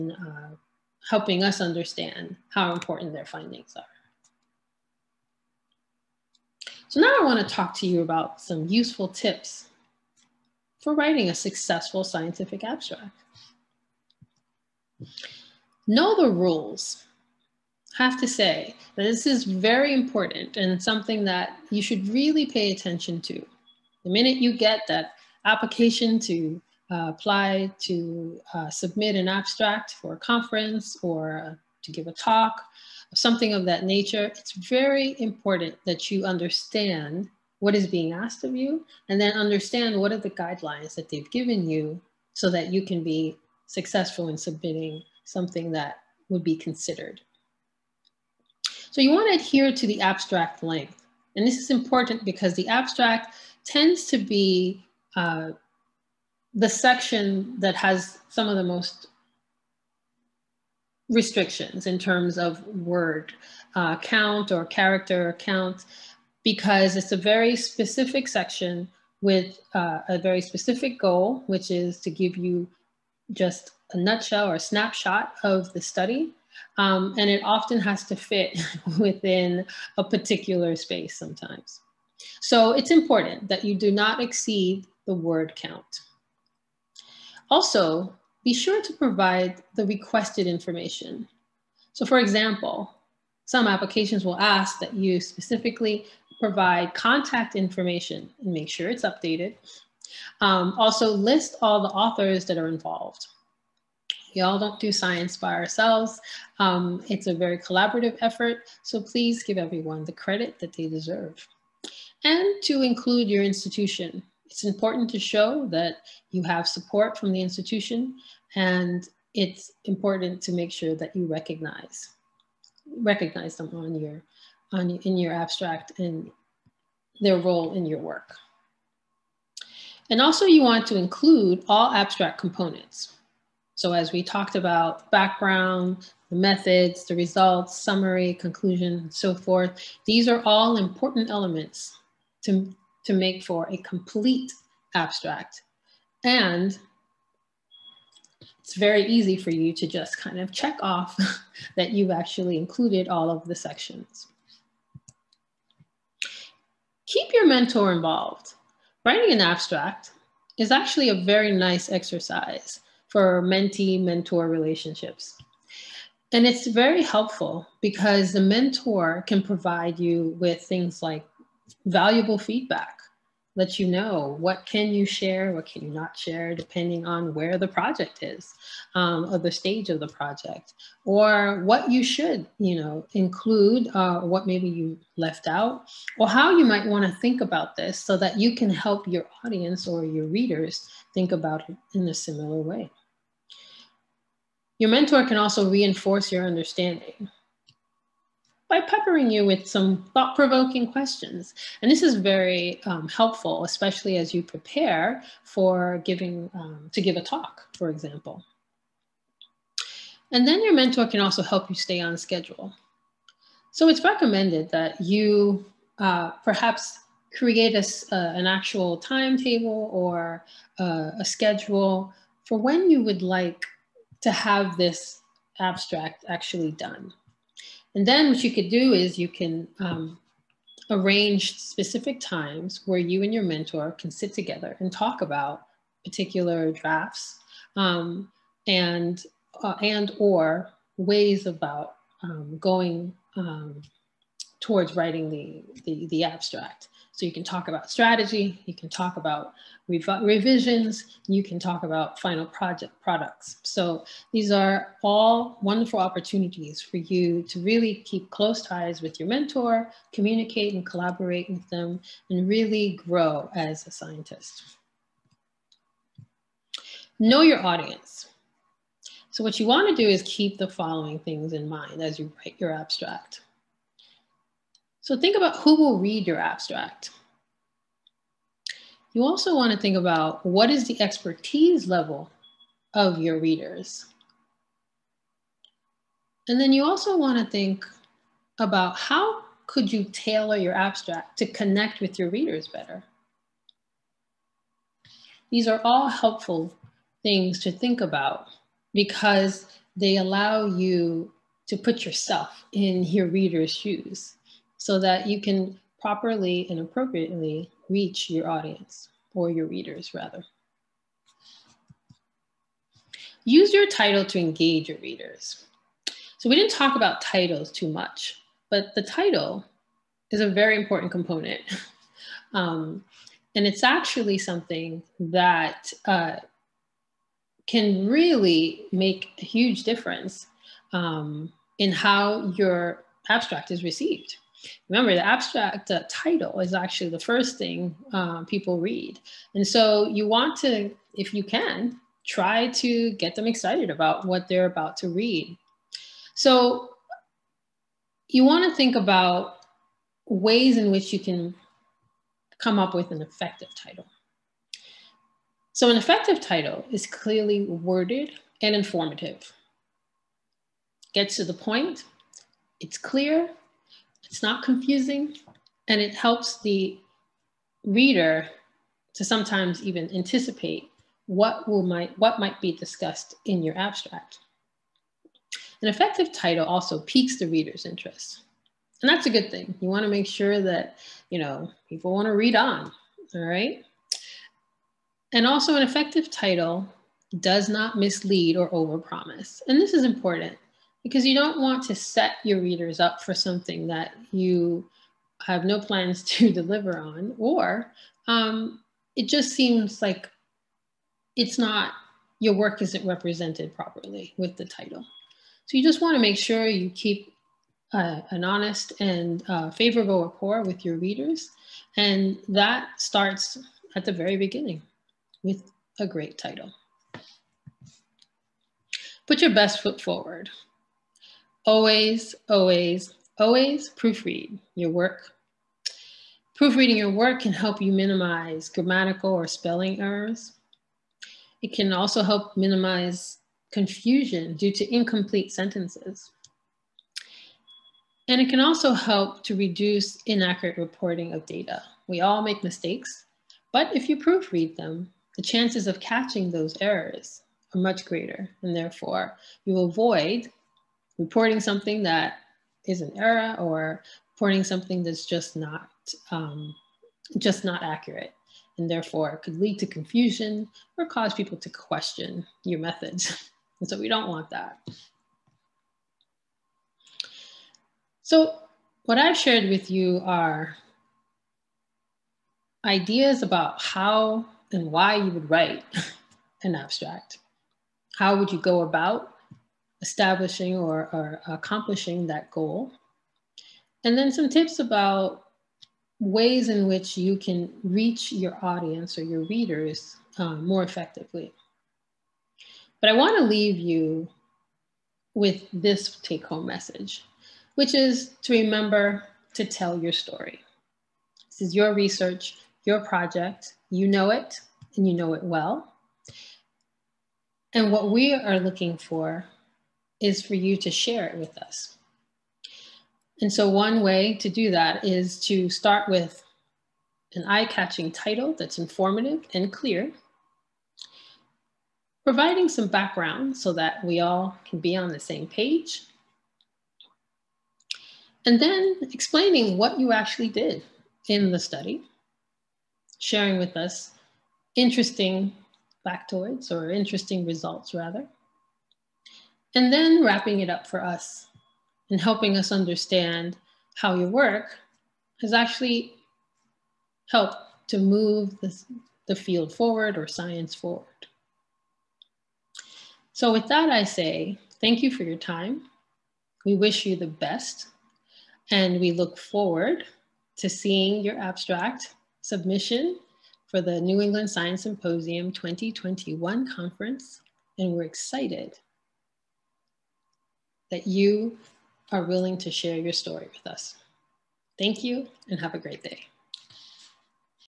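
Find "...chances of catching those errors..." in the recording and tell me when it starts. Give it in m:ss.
7:25.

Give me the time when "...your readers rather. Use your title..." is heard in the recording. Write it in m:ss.
5:09.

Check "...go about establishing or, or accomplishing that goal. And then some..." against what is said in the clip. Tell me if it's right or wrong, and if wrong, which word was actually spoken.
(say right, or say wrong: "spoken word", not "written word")
right.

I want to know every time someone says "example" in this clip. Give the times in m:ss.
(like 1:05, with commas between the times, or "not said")
1:32, 3:27.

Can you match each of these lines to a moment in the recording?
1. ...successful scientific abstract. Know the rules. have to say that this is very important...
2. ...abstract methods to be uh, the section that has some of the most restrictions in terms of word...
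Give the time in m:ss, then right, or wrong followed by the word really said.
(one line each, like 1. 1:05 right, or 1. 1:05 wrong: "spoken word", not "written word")
1. 0:11 right
2. 0:52 wrong: "tends", not "methods".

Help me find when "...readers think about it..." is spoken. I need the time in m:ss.
3:10.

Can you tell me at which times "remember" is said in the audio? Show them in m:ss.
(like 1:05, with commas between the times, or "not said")
5:34, 8:18.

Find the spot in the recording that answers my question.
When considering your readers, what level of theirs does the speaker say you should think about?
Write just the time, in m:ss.
4:41.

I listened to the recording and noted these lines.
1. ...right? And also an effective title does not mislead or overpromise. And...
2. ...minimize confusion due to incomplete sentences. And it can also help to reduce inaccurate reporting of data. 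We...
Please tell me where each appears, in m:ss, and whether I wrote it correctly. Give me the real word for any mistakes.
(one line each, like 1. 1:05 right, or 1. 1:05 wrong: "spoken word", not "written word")
1. 6:23 right
2. 7:12 right.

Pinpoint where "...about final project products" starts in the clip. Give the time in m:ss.
4:11.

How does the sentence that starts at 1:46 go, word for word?
Um, it's a very collaborative effort, so please give everyone the credit that they deserve.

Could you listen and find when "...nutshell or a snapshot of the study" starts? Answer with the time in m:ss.
1:13.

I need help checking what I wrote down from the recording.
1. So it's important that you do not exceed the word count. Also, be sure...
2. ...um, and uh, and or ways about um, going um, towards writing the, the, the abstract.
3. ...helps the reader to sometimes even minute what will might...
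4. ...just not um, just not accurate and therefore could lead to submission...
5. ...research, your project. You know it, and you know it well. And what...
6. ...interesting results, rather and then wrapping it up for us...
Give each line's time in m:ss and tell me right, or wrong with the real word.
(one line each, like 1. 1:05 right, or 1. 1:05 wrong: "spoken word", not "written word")
1. 1:22 right
2. 3:57 right
3. 6:06 wrong: "anticipate", not "minute"
4. 7:35 wrong: "confusion", not "submission"
5. 8:21 right
6. 8:56 right.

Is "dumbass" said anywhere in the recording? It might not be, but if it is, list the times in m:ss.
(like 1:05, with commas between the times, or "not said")
not said.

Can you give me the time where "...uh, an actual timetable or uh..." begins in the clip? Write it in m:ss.
3:38.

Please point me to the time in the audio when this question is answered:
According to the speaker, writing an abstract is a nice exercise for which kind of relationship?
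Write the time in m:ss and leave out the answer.
2:43.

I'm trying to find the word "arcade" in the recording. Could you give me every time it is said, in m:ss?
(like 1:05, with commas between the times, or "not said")
not said.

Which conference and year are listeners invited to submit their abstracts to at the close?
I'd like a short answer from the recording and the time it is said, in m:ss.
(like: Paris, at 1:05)
New England Science Symposium 2021, at 9:24.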